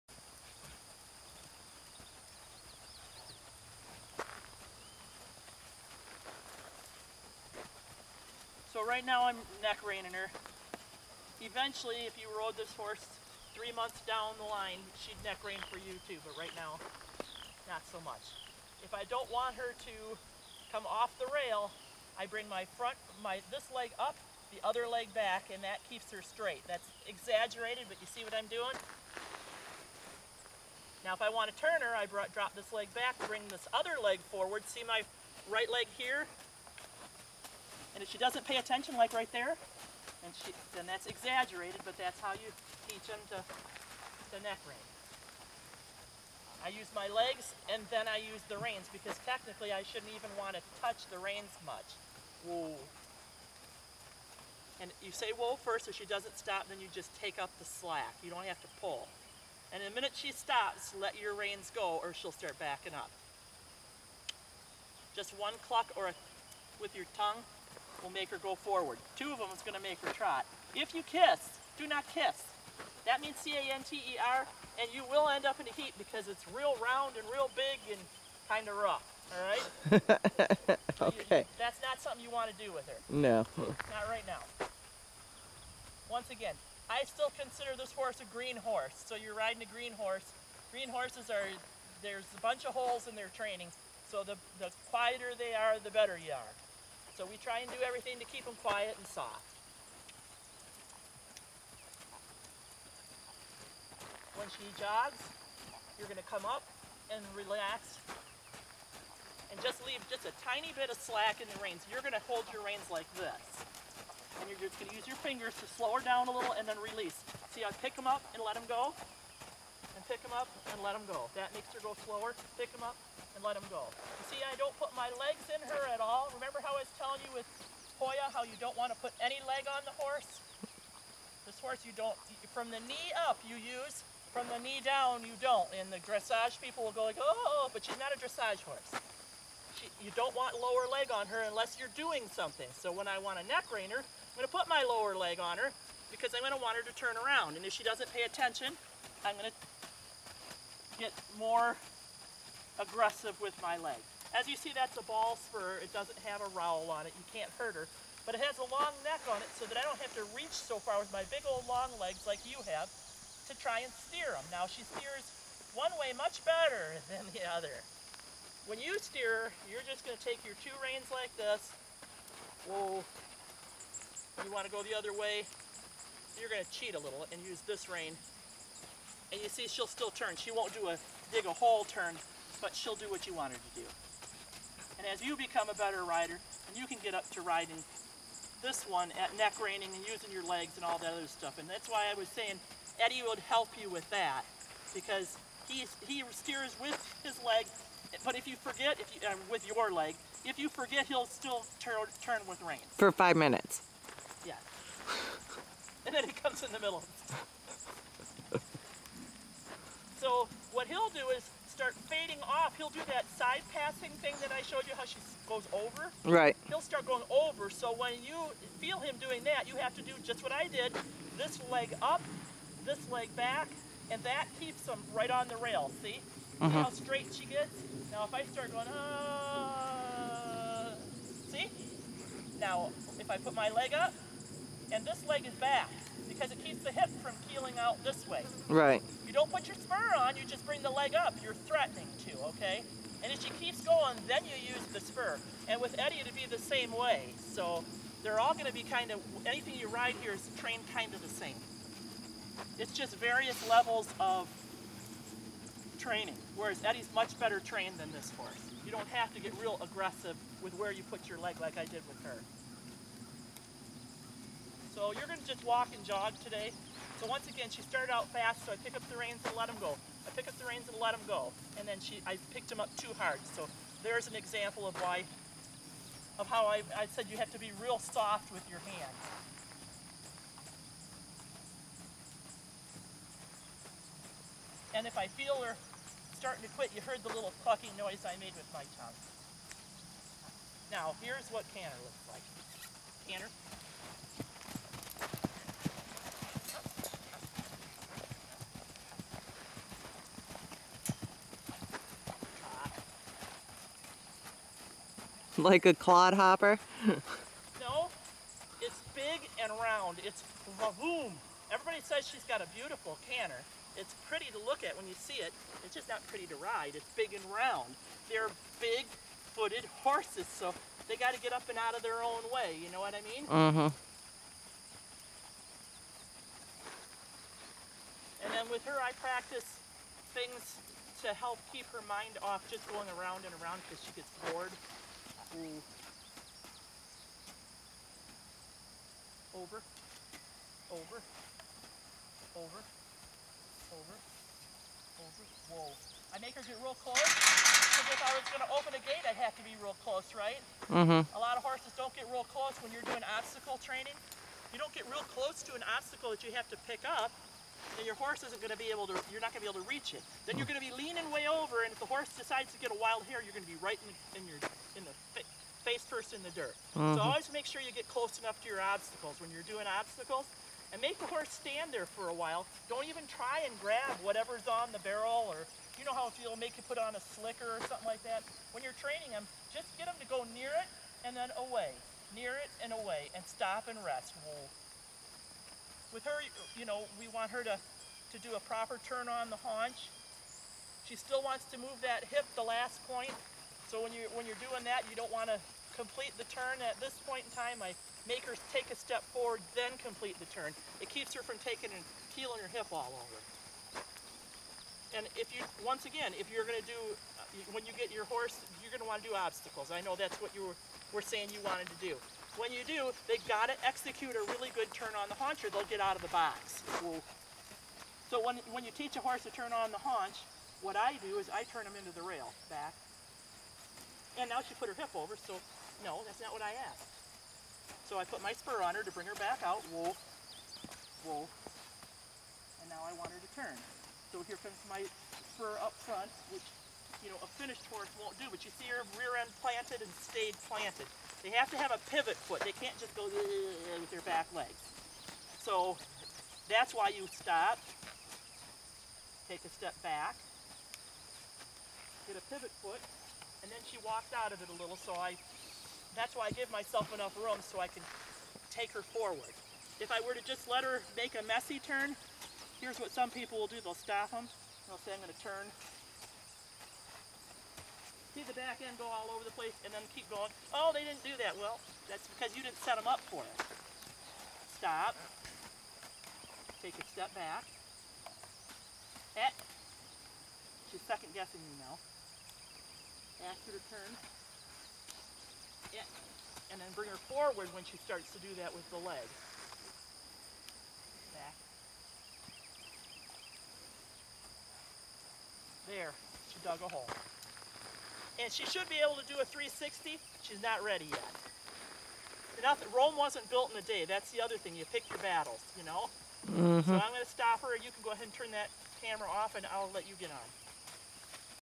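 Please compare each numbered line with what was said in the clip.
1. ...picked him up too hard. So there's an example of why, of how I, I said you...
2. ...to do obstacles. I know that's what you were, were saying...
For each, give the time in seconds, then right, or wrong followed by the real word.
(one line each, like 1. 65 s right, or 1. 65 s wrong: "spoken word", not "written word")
1. 272 s right
2. 409 s right.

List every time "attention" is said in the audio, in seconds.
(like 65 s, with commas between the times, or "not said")
38 s, 148 s.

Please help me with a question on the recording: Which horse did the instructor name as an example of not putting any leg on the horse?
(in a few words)
Hoya.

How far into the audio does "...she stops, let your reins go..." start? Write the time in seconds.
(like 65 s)
60 s.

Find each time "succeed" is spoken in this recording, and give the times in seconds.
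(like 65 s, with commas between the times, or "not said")
not said.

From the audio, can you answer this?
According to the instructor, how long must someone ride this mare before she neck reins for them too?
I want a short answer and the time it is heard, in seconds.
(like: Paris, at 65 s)
3 months, at 13 s.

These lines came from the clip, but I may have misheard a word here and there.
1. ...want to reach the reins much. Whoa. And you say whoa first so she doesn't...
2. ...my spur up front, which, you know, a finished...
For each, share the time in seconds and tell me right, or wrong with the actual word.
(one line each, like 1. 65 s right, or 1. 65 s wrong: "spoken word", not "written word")
1. 50 s wrong: "touch", not "reach"
2. 434 s right.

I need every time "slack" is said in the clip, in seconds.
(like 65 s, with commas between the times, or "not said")
57 s, 110 s.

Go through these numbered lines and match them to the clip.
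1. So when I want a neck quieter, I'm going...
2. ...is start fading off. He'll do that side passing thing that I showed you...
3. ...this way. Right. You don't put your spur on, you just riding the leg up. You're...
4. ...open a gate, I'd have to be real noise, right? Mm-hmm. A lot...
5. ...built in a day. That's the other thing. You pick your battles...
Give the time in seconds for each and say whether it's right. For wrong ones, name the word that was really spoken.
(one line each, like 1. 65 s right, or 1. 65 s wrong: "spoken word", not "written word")
1. 142 s wrong: "reiner", not "quieter"
2. 211 s right
3. 238 s wrong: "bring", not "riding"
4. 348 s wrong: "close", not "noise"
5. 503 s right.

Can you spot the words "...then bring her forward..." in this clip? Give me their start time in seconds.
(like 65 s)
486 s.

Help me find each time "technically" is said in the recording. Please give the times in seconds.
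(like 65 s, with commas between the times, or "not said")
49 s.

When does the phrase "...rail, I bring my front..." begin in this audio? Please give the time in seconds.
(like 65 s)
21 s.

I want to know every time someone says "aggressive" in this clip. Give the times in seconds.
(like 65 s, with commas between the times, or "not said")
152 s, 259 s.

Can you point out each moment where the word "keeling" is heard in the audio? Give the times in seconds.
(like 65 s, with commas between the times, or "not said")
237 s, 402 s.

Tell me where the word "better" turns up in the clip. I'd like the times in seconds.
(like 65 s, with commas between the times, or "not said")
95 s, 166 s, 185 s, 257 s.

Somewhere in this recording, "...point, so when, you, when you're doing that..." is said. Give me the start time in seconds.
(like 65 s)
393 s.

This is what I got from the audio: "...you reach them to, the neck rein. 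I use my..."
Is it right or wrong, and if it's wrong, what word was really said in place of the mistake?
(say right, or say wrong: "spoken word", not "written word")
wrong: "teach", not "reach".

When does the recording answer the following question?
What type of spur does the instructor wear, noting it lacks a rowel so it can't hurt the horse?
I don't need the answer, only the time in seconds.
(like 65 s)
155 s.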